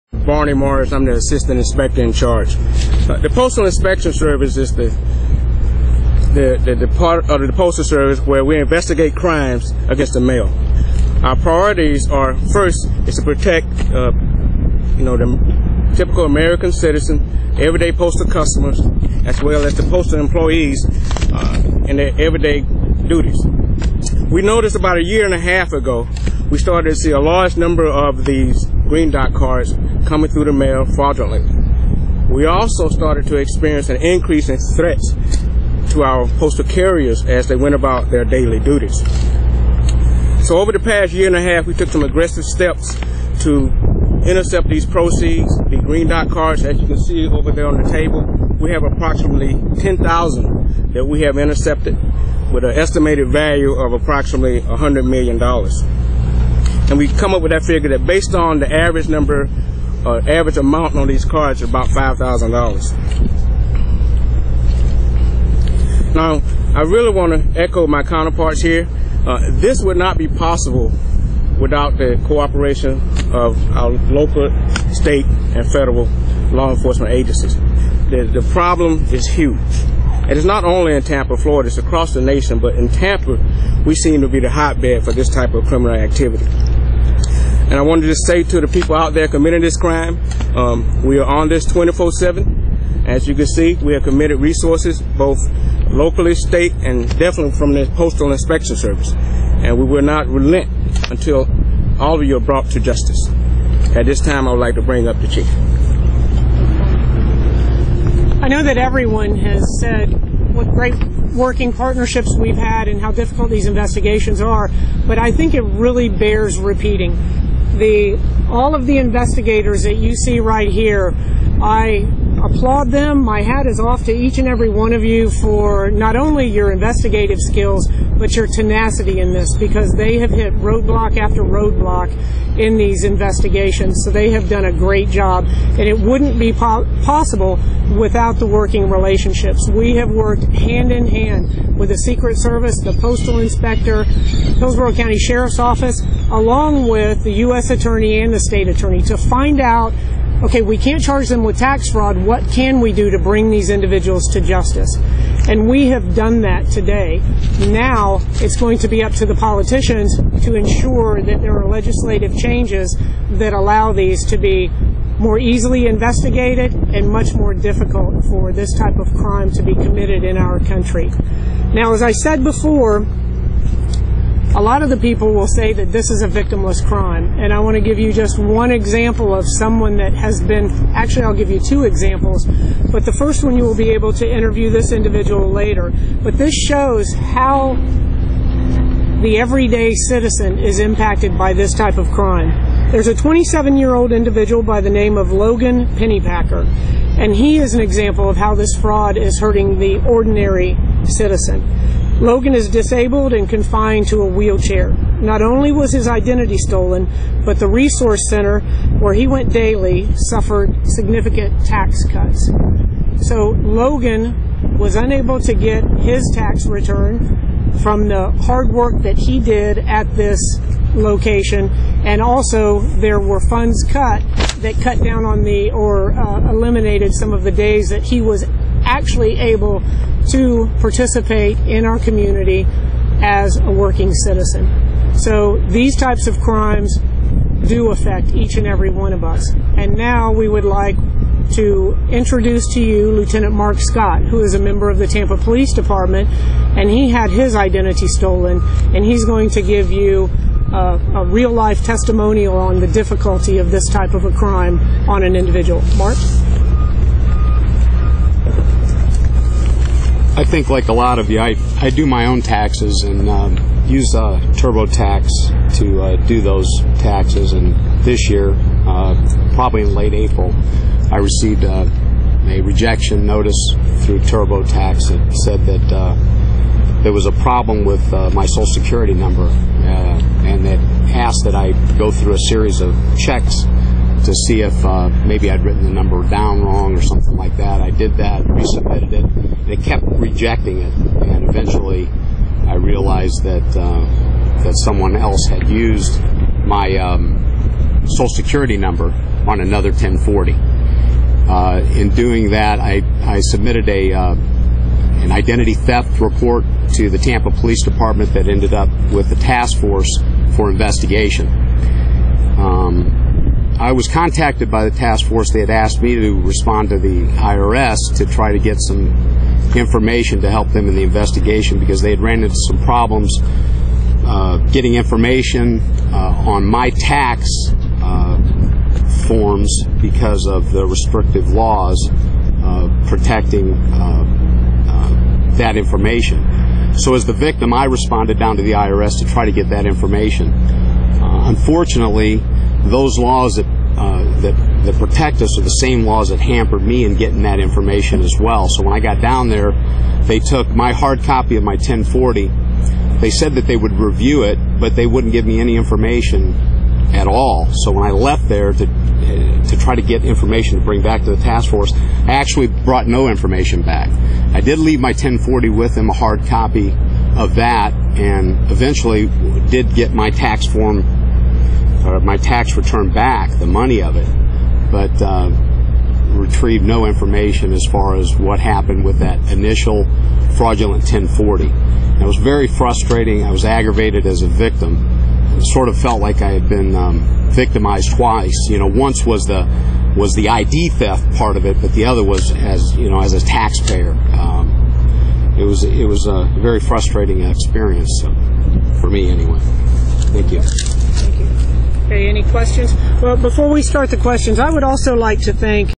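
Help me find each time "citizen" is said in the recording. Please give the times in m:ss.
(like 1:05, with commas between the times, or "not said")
0:16, 3:09, 3:21, 3:54.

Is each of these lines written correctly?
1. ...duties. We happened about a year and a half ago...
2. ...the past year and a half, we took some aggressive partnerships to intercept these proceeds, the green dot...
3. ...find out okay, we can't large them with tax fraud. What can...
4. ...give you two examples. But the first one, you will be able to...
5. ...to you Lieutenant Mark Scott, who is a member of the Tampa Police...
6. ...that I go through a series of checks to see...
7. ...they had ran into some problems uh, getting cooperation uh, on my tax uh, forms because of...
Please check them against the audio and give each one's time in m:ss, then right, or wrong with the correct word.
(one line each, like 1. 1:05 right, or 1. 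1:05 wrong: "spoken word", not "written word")
1. 0:23 wrong: "noticed", not "happened"
2. 0:40 wrong: "steps", not "partnerships"
3. 2:29 wrong: "charge", not "large"
4. 3:01 right
5. 4:02 right
6. 4:41 right
7. 5:21 wrong: "information", not "cooperation".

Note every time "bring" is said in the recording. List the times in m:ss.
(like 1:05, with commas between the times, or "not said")
1:44, 2:33, 6:00.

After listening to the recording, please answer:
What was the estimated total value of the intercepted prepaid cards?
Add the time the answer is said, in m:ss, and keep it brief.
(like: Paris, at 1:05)
$100 million, at 0:54.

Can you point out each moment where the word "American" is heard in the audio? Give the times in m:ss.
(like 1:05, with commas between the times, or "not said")
0:16.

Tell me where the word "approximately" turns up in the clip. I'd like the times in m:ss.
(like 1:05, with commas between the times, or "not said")
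0:48, 0:53.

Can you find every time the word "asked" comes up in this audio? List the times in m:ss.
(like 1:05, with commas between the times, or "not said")
4:41, 5:15.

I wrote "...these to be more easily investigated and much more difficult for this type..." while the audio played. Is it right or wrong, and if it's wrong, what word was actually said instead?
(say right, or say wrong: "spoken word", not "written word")
right.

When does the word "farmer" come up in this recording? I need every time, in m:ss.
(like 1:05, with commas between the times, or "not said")
not said.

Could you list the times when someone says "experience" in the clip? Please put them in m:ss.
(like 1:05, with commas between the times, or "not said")
0:33, 6:37.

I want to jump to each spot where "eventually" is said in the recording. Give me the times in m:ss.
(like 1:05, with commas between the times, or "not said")
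4:51, 6:08.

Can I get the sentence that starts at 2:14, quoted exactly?
So they have done a great job, and it wouldn't be po possible without the working relationships.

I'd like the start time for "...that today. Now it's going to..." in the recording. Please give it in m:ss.
2:36.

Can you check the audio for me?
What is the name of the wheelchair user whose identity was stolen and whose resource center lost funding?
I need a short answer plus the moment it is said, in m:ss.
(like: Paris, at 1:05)
Logan Pennypacker, at 3:15.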